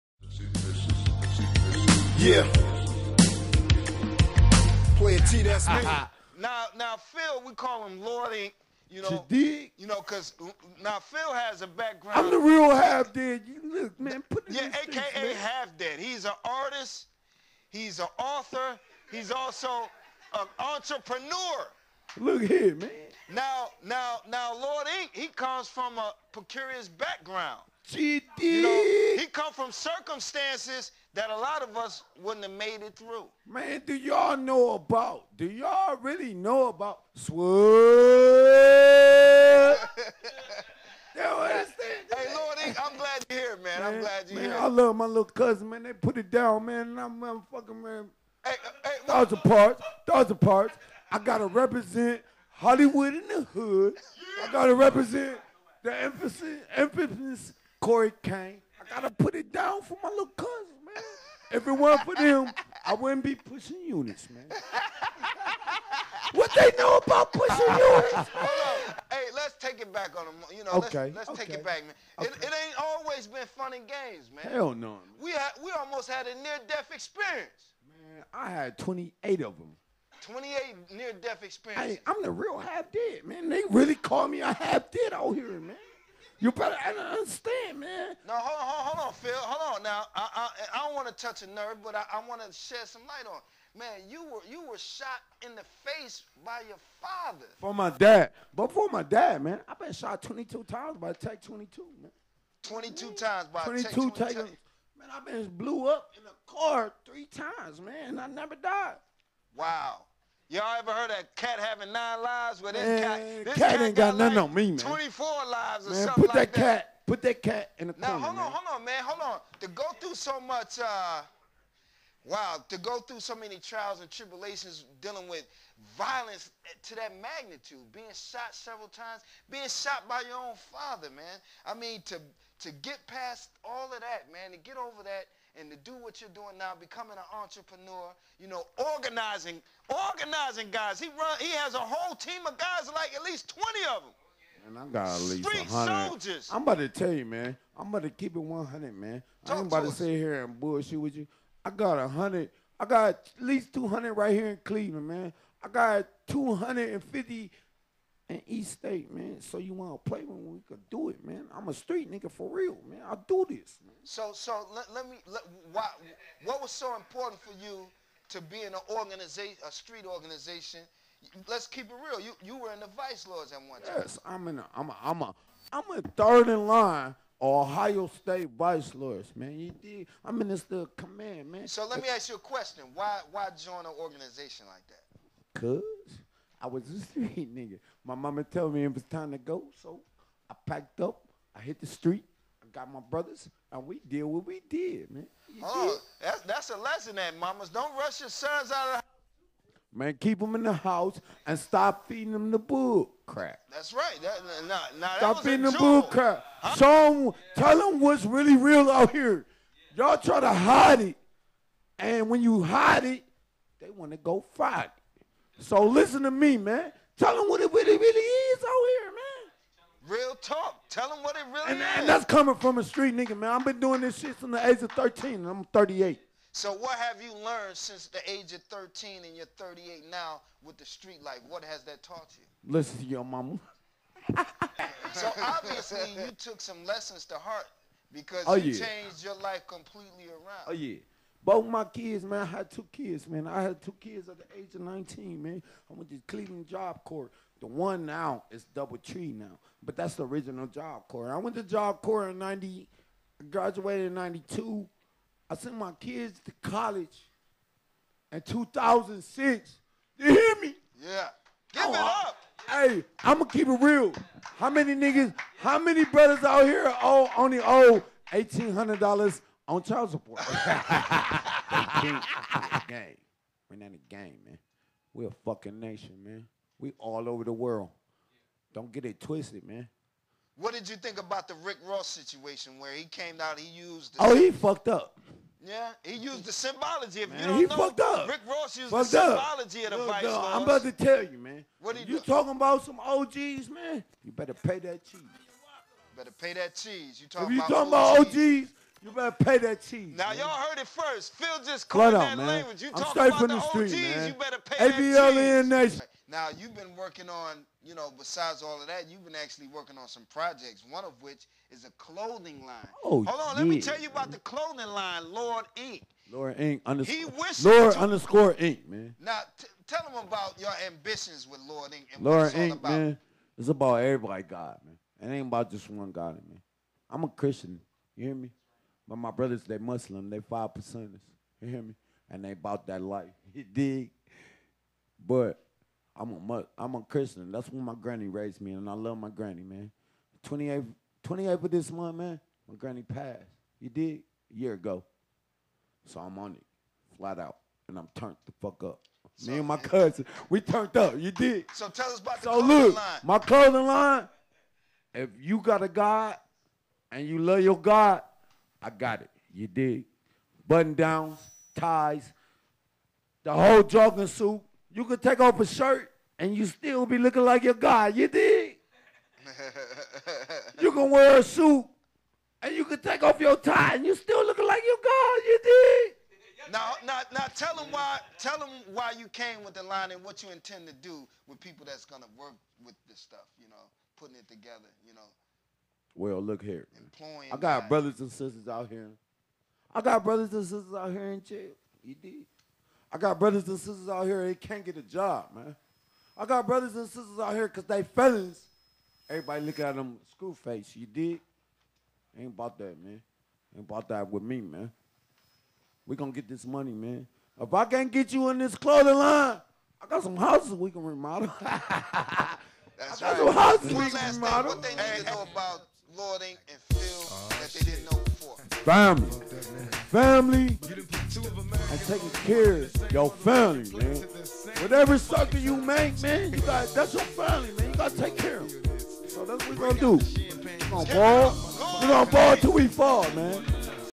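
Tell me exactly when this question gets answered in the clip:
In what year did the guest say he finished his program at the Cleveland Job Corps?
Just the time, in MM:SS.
04:14.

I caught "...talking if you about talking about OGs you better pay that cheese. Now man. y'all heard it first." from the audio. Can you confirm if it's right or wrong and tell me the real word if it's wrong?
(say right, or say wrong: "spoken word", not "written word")
right.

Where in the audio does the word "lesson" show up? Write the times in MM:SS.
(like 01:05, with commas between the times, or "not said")
03:16, 03:56.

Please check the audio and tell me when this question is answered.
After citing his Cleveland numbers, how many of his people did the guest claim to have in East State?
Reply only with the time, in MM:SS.
02:36.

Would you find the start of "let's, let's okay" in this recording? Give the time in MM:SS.
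01:11.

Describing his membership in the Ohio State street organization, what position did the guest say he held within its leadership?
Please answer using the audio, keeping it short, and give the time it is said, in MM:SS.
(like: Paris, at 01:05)
third in line, at 02:56.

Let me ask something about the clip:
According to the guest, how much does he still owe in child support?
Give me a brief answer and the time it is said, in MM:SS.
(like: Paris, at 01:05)
$1,800, at 04:28.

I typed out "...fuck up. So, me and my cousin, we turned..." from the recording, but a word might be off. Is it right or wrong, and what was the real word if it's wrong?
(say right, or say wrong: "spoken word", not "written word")
right.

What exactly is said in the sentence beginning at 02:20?
He run, he has a whole team of guys, like at least 20 of them.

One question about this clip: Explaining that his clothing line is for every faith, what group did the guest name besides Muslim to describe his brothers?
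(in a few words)
five percenters.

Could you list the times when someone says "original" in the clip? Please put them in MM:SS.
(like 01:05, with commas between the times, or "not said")
04:10.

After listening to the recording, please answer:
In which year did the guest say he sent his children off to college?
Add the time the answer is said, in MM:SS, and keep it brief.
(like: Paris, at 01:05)
2006, at 04:18.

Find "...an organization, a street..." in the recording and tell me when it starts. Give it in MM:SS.
02:48.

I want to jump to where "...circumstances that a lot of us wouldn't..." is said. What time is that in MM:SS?
00:29.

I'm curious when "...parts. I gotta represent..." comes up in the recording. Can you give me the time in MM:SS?
00:50.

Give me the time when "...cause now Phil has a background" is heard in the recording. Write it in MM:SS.
00:10.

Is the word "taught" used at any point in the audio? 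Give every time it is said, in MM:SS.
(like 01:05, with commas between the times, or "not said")
03:52.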